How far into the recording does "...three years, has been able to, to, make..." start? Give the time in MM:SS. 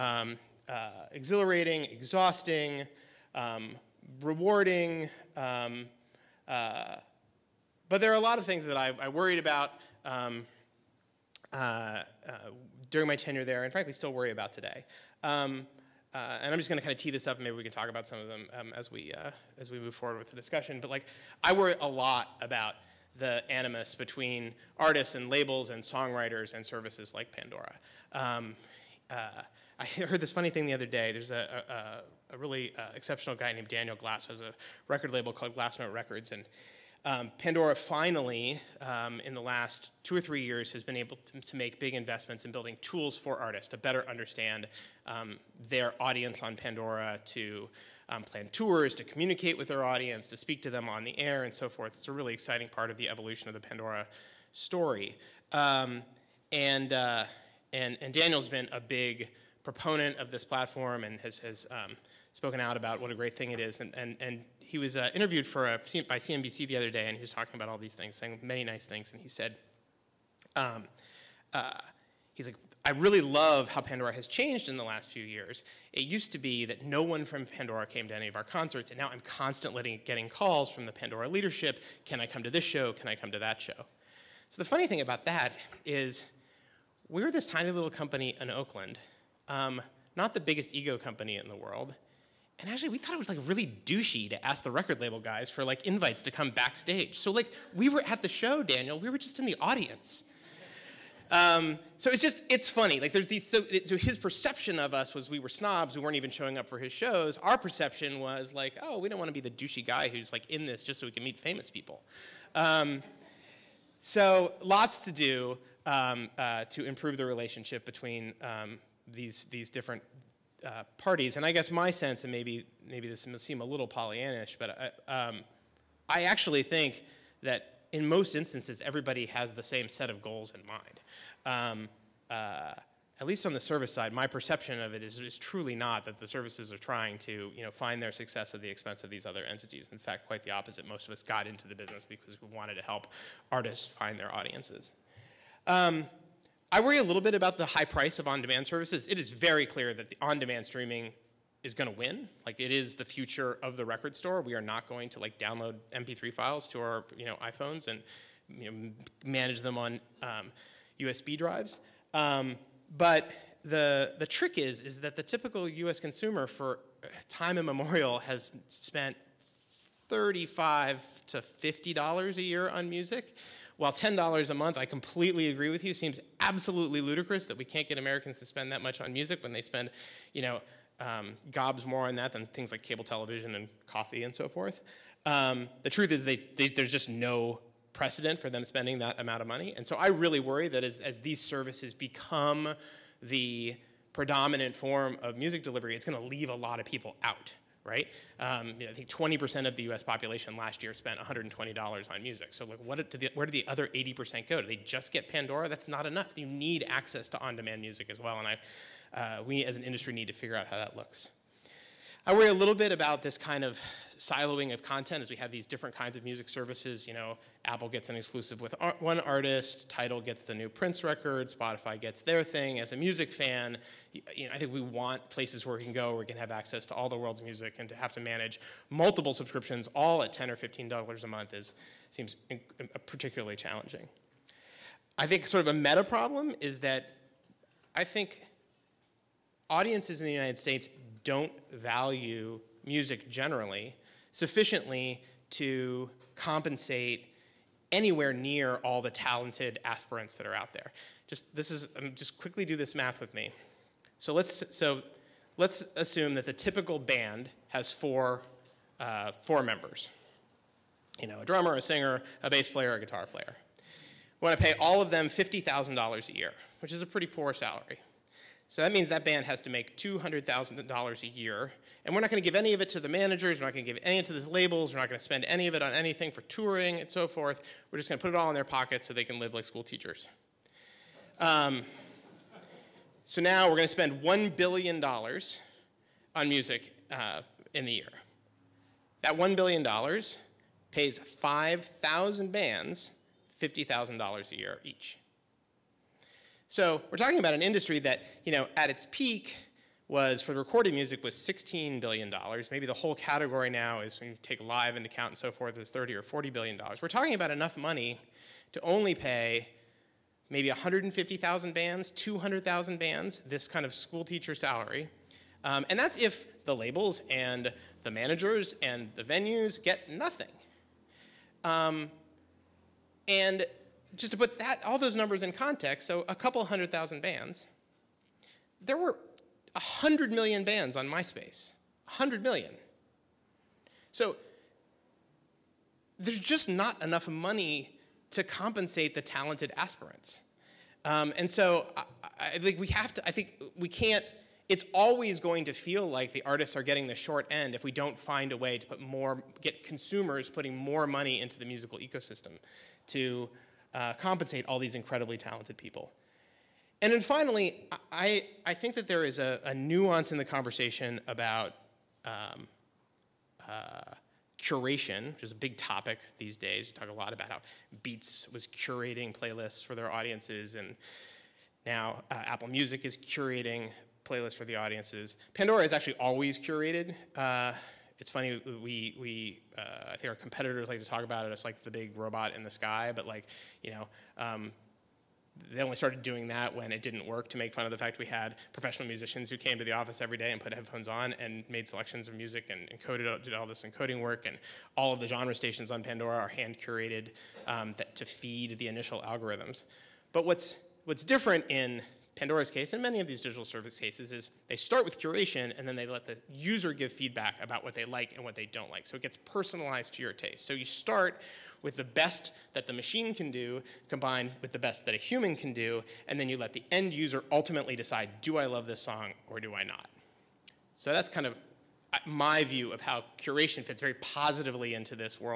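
00:40.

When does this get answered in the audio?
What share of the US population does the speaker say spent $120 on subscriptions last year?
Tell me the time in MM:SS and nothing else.
03:19.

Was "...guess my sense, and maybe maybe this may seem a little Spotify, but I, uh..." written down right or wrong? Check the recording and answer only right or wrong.
wrong.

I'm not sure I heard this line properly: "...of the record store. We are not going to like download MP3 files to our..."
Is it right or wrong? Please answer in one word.
right.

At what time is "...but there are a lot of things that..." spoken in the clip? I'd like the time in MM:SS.
00:07.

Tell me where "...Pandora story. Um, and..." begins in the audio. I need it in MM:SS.
00:53.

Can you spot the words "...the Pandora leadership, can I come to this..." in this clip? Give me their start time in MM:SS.
01:20.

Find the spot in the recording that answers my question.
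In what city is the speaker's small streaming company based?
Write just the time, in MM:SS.
01:28.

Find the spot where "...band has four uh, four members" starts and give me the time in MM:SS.
04:16.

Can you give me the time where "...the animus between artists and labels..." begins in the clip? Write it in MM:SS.
00:23.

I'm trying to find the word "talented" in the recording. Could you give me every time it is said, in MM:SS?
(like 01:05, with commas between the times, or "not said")
04:09, 05:39, 05:55.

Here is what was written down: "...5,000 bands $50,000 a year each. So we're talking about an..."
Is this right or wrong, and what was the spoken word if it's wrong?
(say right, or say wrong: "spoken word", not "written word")
right.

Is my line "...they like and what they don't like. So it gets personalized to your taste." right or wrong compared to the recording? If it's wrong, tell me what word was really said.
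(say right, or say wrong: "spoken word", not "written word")
right.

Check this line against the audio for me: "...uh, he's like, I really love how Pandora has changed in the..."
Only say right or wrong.
right.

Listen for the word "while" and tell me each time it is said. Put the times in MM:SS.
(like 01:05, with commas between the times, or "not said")
02:53.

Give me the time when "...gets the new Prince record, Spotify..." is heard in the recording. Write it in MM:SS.
03:40.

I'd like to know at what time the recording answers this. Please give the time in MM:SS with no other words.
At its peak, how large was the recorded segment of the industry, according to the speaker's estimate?
05:01.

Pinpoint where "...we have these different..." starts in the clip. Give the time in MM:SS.
03:35.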